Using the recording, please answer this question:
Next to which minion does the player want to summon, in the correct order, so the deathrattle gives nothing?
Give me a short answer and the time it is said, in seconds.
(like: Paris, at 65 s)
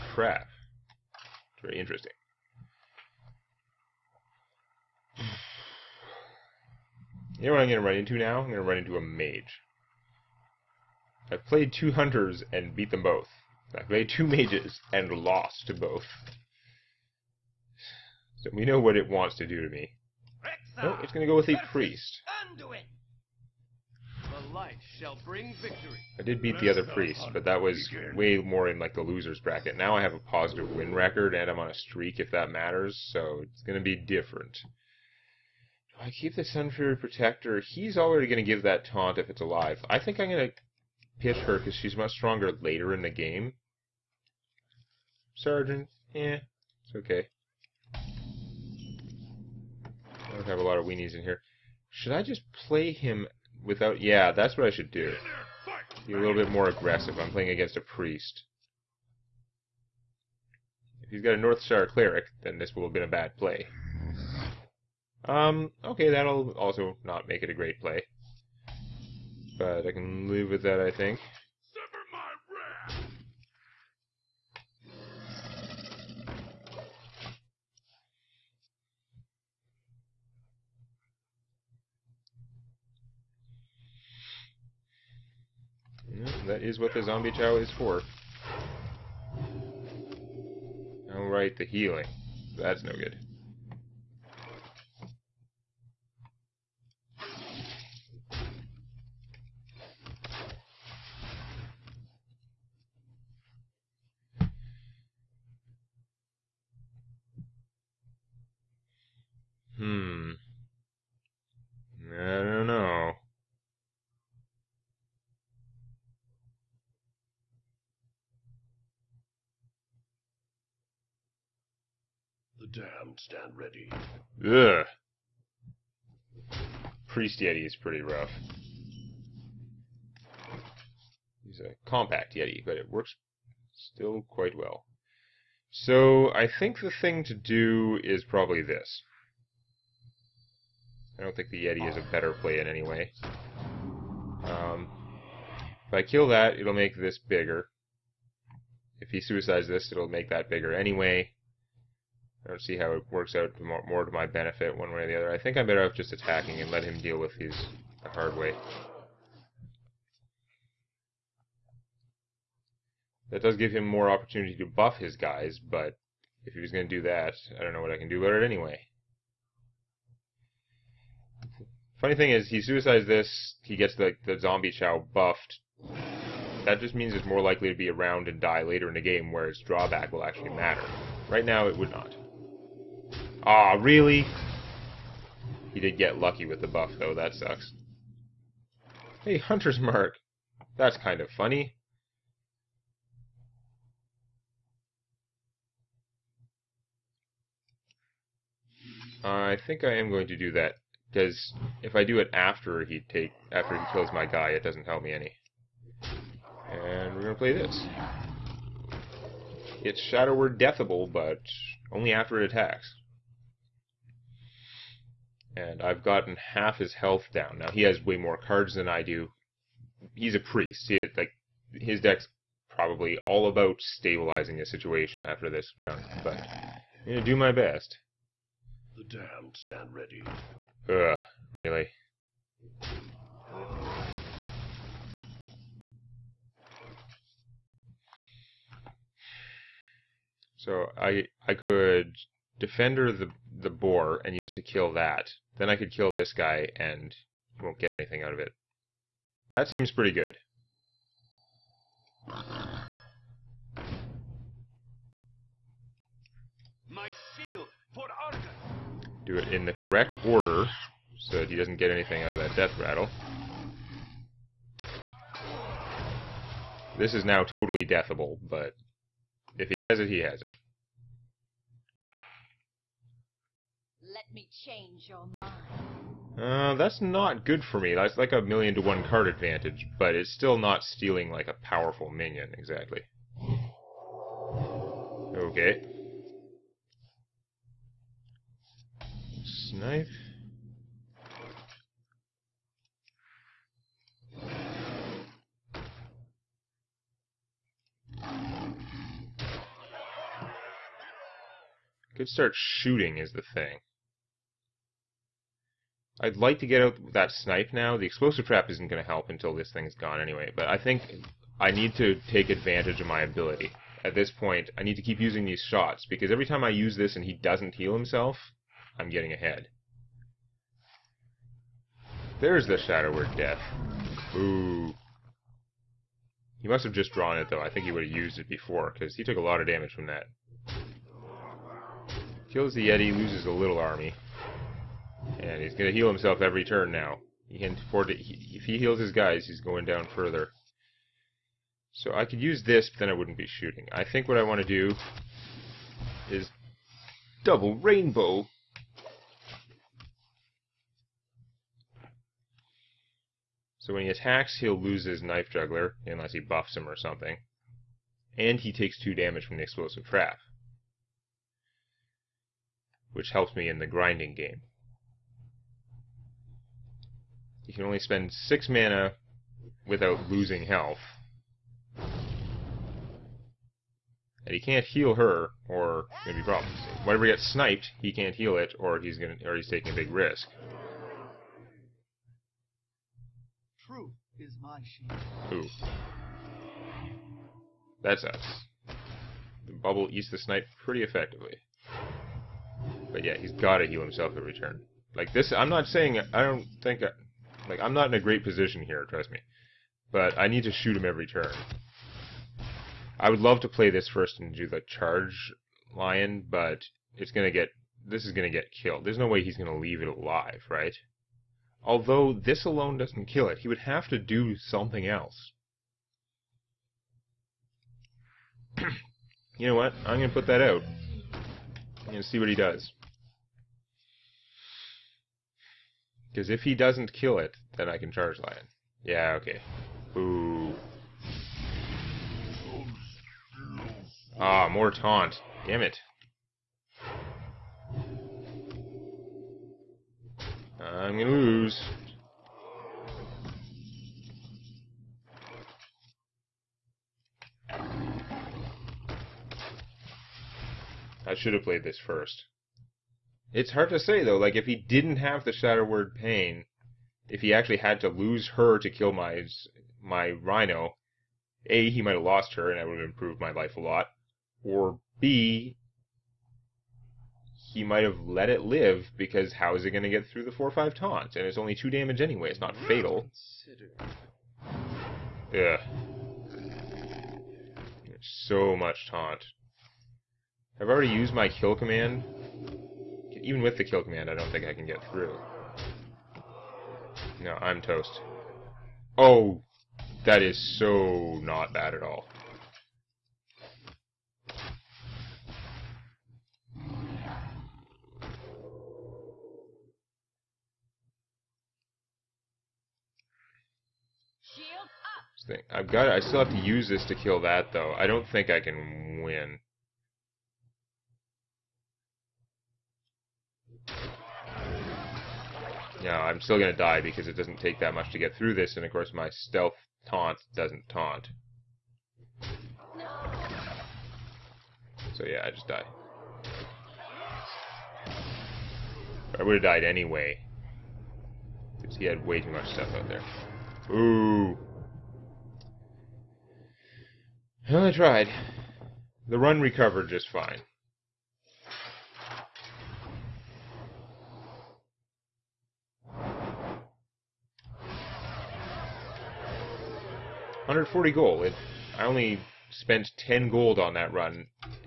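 Argus, at 258 s.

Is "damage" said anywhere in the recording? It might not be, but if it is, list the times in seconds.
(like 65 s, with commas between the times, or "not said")
329 s, 359 s, 471 s.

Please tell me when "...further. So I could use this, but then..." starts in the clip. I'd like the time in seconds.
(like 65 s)
340 s.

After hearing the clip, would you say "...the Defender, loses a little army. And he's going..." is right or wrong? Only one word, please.
wrong.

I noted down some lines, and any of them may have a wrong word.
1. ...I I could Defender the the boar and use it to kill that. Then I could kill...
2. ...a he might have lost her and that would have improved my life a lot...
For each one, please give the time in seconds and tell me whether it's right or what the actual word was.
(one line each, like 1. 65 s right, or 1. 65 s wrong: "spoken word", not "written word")
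1. 240 s right
2. 461 s right.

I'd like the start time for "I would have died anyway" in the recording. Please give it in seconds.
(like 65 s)
529 s.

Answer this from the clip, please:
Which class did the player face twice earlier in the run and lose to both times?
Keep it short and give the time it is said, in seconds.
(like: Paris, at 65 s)
Mage, at 14 s.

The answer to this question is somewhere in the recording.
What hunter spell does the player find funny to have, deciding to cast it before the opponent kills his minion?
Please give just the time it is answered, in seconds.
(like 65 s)
189 s.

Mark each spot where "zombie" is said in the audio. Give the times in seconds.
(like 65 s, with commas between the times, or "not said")
87 s, 174 s.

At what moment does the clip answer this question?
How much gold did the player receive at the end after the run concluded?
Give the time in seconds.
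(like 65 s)
550 s.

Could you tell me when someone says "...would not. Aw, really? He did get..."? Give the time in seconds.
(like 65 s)
181 s.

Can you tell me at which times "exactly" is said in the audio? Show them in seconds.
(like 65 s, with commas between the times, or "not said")
282 s.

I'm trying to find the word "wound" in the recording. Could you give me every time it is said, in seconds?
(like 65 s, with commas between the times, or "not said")
not said.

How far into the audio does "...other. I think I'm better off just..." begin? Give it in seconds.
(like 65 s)
155 s.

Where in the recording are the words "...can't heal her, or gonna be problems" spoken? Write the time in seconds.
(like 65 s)
374 s.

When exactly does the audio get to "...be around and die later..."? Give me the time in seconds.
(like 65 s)
177 s.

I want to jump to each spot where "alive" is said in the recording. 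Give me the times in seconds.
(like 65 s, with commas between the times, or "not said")
39 s, 410 s.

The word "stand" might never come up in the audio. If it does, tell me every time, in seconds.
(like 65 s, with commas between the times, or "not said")
123 s, 229 s.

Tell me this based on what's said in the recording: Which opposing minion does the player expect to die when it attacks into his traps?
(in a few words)
Knife Juggler.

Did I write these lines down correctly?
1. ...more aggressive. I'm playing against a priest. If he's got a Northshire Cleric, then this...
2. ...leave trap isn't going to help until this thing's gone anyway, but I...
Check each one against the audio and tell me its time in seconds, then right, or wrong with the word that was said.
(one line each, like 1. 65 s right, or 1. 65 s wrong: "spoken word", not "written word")
1. 56 s right
2. 308 s wrong: "explosive", not "leave".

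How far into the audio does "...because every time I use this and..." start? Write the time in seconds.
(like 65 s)
316 s.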